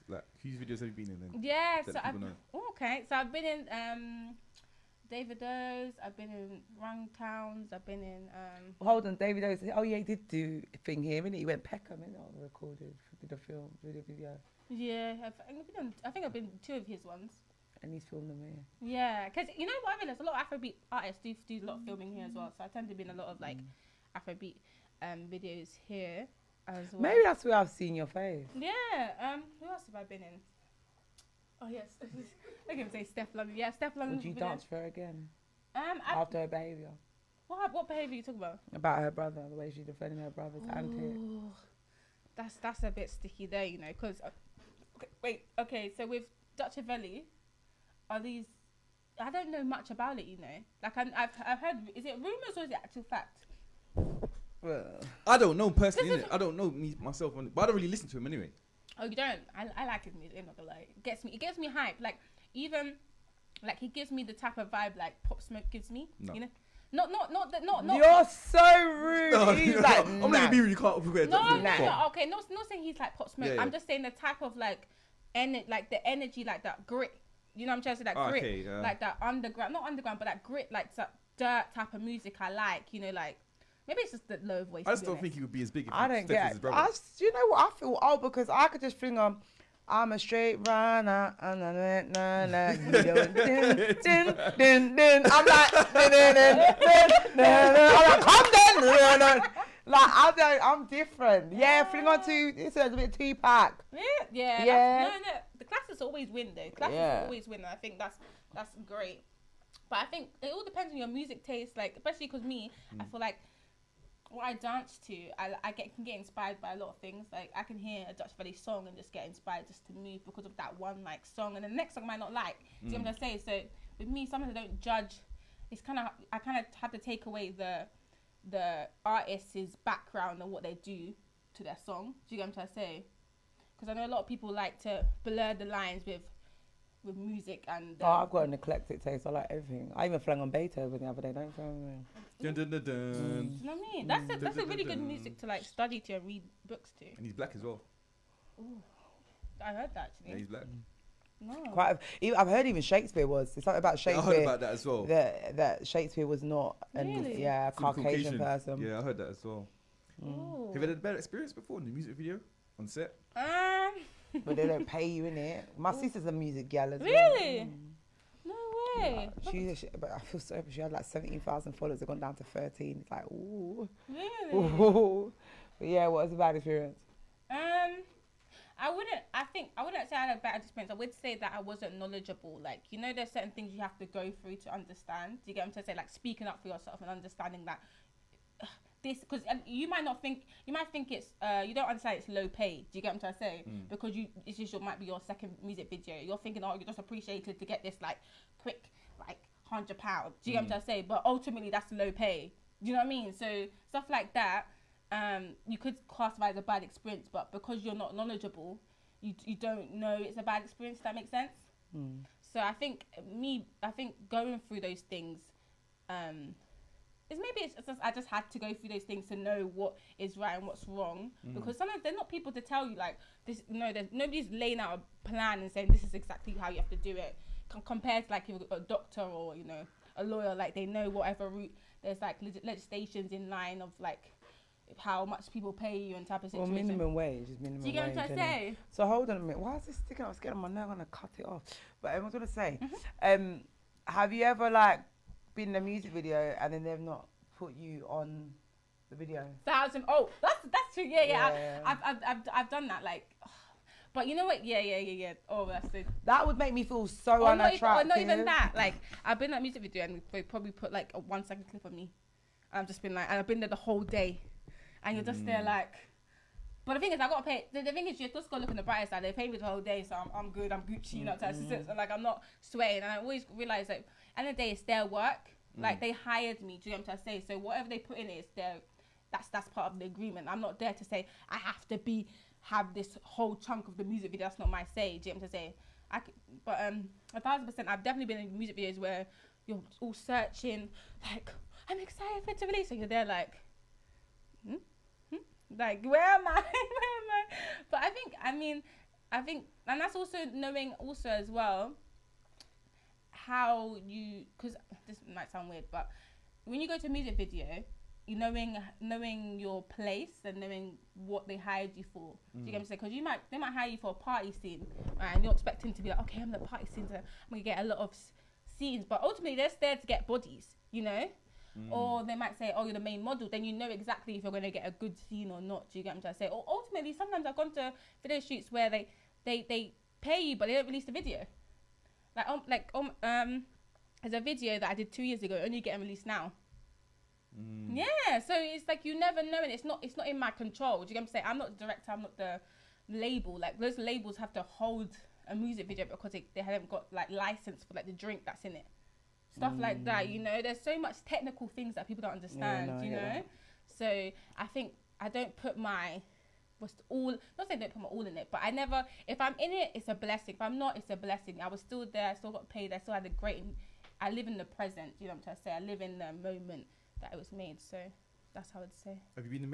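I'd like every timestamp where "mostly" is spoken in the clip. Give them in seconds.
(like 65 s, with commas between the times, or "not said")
not said.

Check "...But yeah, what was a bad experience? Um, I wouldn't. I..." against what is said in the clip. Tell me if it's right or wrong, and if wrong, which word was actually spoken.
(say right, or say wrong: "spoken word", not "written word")
right.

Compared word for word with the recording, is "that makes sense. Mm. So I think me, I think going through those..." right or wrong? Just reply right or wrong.
right.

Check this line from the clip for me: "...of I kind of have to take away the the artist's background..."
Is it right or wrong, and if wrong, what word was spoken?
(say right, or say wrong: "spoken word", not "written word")
right.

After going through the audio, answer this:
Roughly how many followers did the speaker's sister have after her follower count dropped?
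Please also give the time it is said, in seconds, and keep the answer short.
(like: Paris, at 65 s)
13,000, at 172 s.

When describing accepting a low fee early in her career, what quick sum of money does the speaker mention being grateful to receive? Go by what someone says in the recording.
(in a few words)
£100.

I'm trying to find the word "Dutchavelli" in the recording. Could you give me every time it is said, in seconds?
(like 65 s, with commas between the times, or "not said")
46 s, 118 s.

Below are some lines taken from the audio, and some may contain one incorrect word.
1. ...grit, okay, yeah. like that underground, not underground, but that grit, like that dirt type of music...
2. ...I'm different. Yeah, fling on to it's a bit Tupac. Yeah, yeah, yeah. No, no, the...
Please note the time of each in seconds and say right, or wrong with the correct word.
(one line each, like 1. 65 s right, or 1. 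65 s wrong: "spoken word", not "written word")
1. 78 s right
2. 100 s right.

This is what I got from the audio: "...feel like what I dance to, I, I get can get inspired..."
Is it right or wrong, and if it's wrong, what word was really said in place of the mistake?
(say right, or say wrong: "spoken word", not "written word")
right.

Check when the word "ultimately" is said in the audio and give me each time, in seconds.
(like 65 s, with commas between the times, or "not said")
201 s, 319 s, 326 s.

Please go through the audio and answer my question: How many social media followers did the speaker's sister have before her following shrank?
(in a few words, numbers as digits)
17,000.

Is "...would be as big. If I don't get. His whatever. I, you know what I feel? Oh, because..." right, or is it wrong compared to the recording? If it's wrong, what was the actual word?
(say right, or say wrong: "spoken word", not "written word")
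wrong: "brother", not "whatever".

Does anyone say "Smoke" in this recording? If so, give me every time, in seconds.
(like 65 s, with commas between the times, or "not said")
65 s, 73 s.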